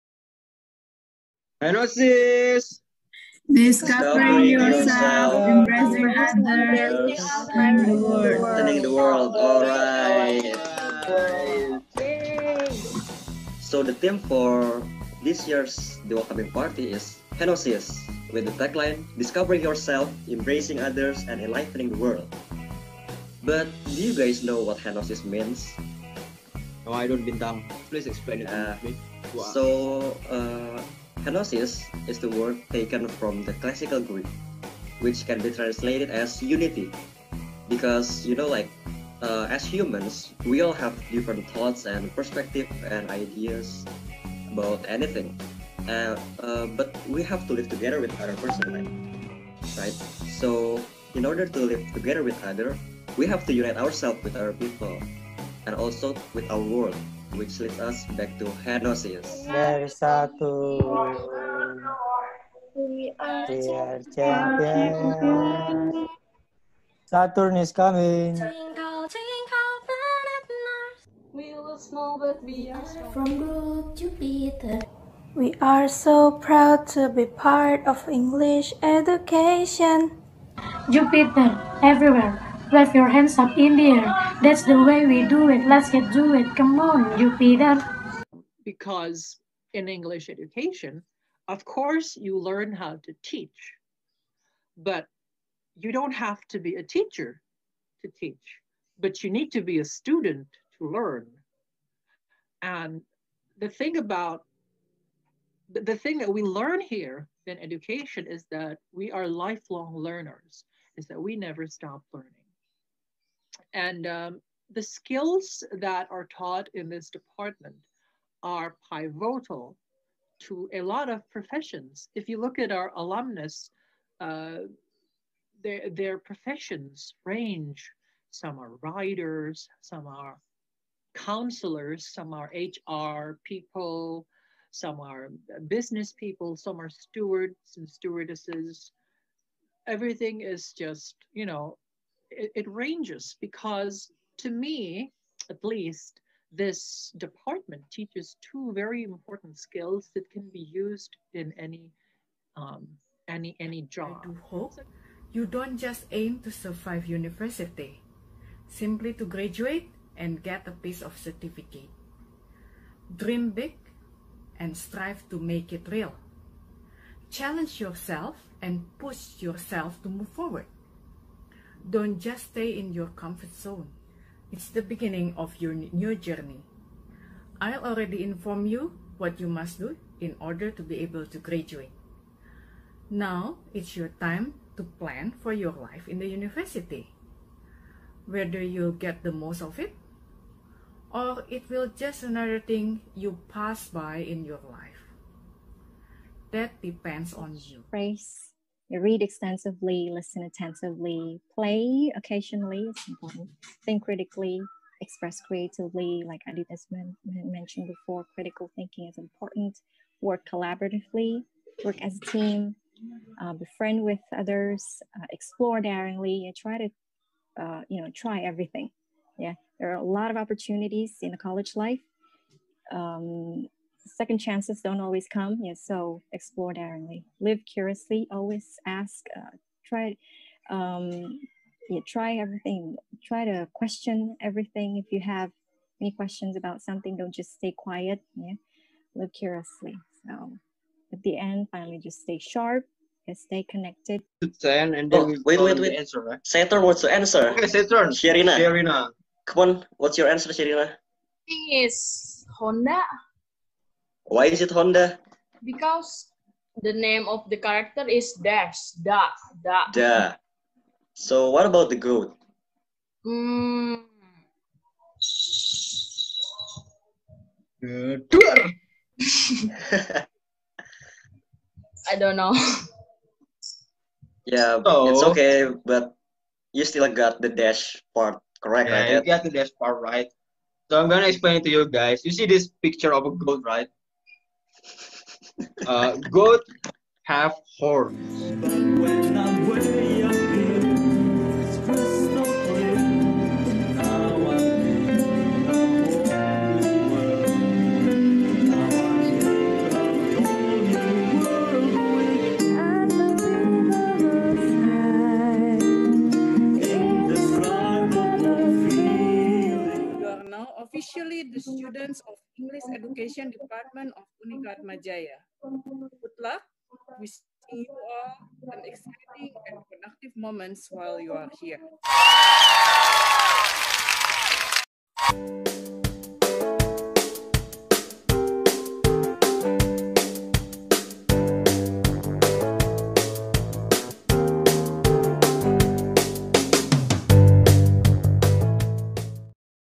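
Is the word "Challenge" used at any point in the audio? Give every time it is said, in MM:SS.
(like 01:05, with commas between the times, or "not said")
02:47.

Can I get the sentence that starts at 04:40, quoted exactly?
So I'm gonna explain it to you guys.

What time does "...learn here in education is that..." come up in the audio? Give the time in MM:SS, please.
01:46.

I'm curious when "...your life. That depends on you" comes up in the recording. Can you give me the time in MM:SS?
03:14.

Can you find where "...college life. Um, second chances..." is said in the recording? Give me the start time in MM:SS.
03:41.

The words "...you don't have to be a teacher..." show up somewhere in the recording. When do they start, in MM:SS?
01:35.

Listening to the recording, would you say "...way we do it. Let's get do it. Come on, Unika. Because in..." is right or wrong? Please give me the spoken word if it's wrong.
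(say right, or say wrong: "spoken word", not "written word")
wrong: "Jupiter", not "Unika".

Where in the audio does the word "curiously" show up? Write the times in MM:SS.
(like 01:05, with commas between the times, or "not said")
03:47, 03:59.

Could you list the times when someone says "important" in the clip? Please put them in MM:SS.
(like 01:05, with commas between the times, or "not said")
02:29, 03:23, 03:29.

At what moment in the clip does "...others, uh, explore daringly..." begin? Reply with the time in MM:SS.
03:34.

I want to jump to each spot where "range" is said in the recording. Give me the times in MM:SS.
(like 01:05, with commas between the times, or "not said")
02:07, 02:22.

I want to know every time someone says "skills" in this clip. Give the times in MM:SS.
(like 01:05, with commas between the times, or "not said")
01:54, 02:29.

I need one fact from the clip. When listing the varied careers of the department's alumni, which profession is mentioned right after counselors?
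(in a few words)
HR people.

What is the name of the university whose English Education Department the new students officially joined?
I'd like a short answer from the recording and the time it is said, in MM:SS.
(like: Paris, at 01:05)
Unika Atma Jaya, at 05:14.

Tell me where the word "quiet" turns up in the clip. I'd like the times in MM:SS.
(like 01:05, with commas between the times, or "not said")
03:57.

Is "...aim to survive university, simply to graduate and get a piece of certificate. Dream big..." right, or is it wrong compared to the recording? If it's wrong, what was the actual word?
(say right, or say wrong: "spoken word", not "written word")
right.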